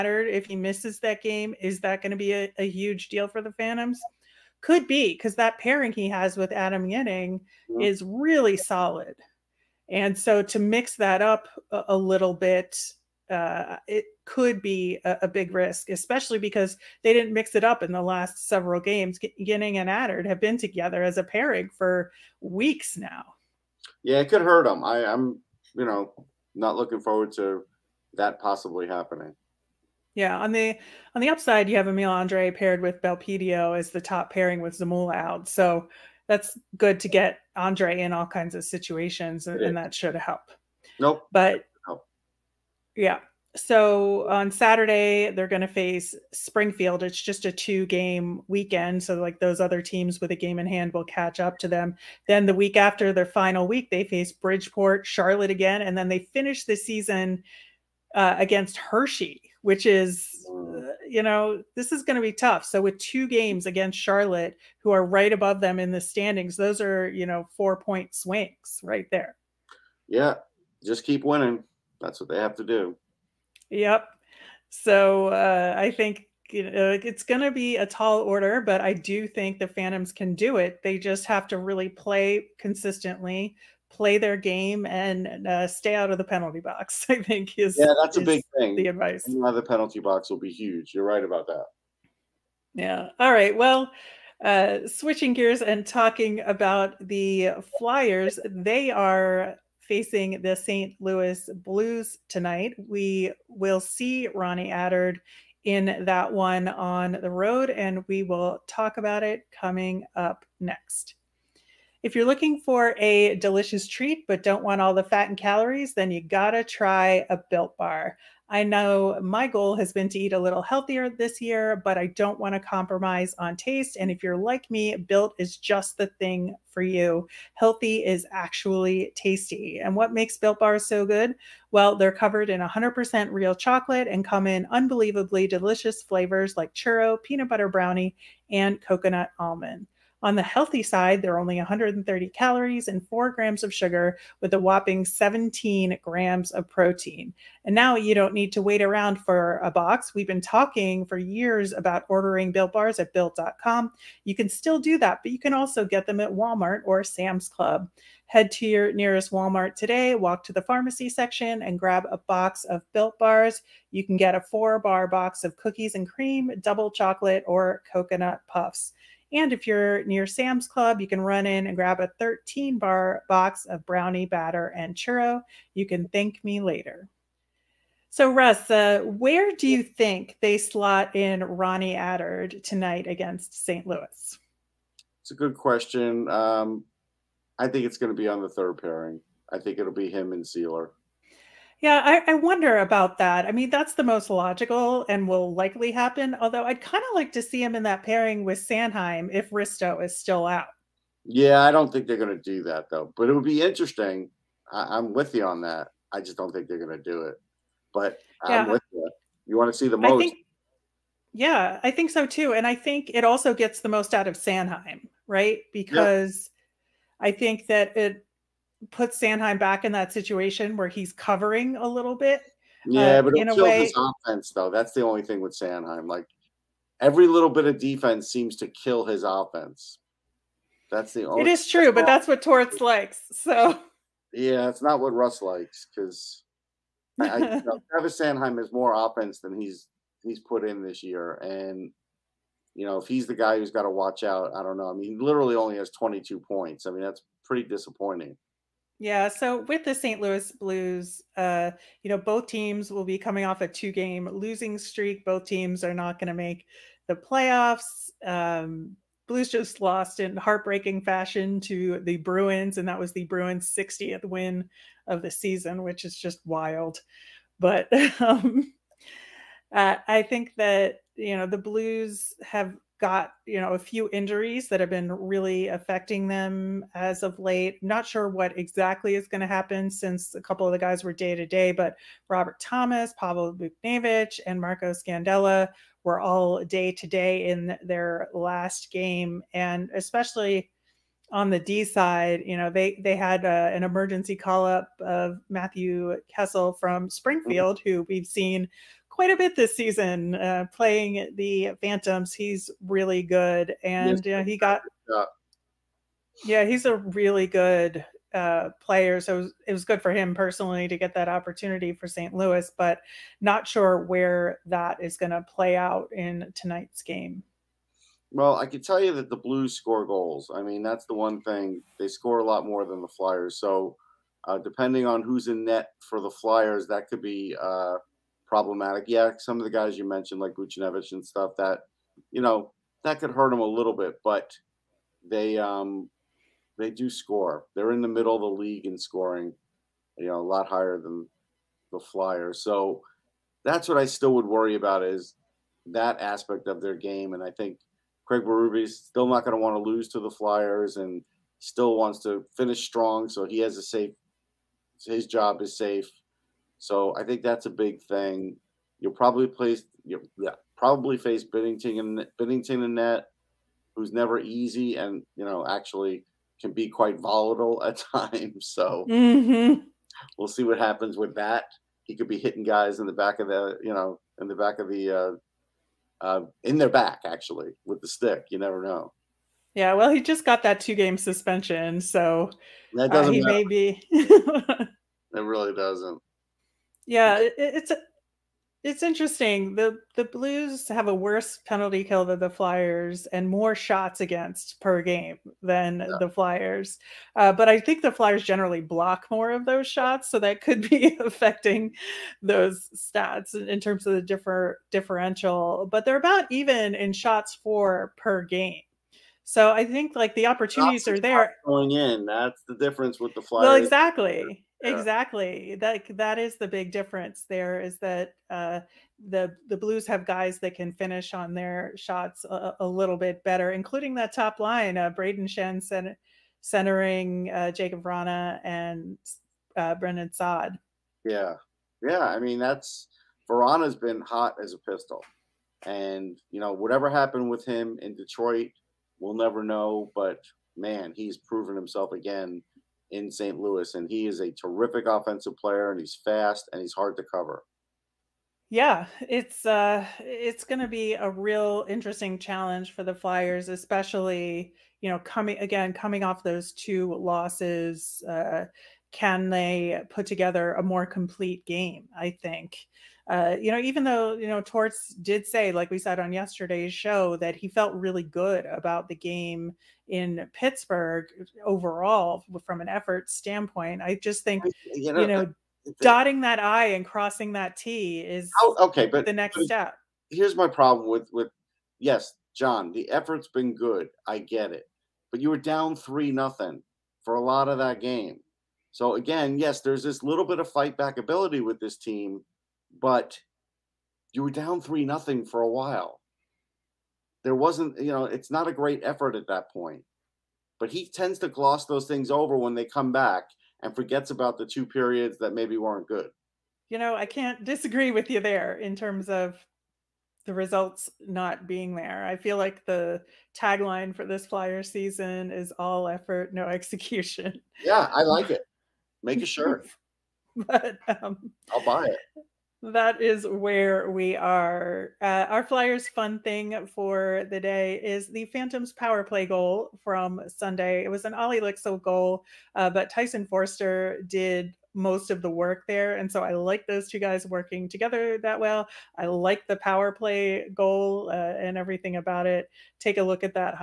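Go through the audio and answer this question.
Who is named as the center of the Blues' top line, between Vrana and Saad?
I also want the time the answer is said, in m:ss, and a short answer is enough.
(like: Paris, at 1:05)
Brayden Schenn, at 7:05.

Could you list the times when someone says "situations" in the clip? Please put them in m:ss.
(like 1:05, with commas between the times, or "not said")
0:38, 3:40.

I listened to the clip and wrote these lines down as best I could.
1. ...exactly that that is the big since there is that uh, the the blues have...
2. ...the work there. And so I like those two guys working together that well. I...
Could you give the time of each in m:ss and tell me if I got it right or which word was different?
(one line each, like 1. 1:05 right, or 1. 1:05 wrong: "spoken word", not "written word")
1. 6:54 wrong: "difference", not "since"
2. 8:55 right.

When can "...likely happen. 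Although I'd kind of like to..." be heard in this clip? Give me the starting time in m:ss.
3:15.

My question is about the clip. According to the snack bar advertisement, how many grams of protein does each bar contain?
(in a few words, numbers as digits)
17.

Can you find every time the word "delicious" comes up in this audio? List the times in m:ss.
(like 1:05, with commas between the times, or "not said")
1:53, 2:15.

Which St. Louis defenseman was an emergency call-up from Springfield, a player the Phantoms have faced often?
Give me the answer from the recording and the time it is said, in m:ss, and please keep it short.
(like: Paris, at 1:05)
Matthew Kessel, at 4:55.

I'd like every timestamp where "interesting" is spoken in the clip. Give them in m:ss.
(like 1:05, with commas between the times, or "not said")
3:23, 6:29, 7:31.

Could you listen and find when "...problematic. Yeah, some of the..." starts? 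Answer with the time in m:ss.
5:28.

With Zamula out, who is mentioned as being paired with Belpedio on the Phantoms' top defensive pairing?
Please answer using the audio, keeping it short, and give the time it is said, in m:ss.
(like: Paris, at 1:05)
Emil Andrae, at 0:31.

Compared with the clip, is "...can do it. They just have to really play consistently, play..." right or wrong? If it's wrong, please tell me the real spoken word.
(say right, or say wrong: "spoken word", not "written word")
right.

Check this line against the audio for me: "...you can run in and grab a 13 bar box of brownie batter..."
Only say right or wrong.
right.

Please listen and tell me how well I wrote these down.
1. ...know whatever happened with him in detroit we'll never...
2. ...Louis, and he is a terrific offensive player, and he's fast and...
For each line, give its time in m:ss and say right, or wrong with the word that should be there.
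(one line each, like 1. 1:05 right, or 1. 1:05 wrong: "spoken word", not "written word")
1. 7:16 right
2. 7:23 right.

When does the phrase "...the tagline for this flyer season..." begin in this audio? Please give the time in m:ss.
8:32.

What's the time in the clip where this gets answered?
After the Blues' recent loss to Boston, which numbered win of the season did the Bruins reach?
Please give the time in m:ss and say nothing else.
4:23.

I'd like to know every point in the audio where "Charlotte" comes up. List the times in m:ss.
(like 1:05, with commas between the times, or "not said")
0:55, 1:03.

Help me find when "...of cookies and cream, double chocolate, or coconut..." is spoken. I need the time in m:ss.
2:45.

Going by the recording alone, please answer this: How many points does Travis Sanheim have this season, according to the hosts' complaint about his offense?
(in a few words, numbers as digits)
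22.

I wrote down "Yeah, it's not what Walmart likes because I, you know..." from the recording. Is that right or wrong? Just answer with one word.
wrong.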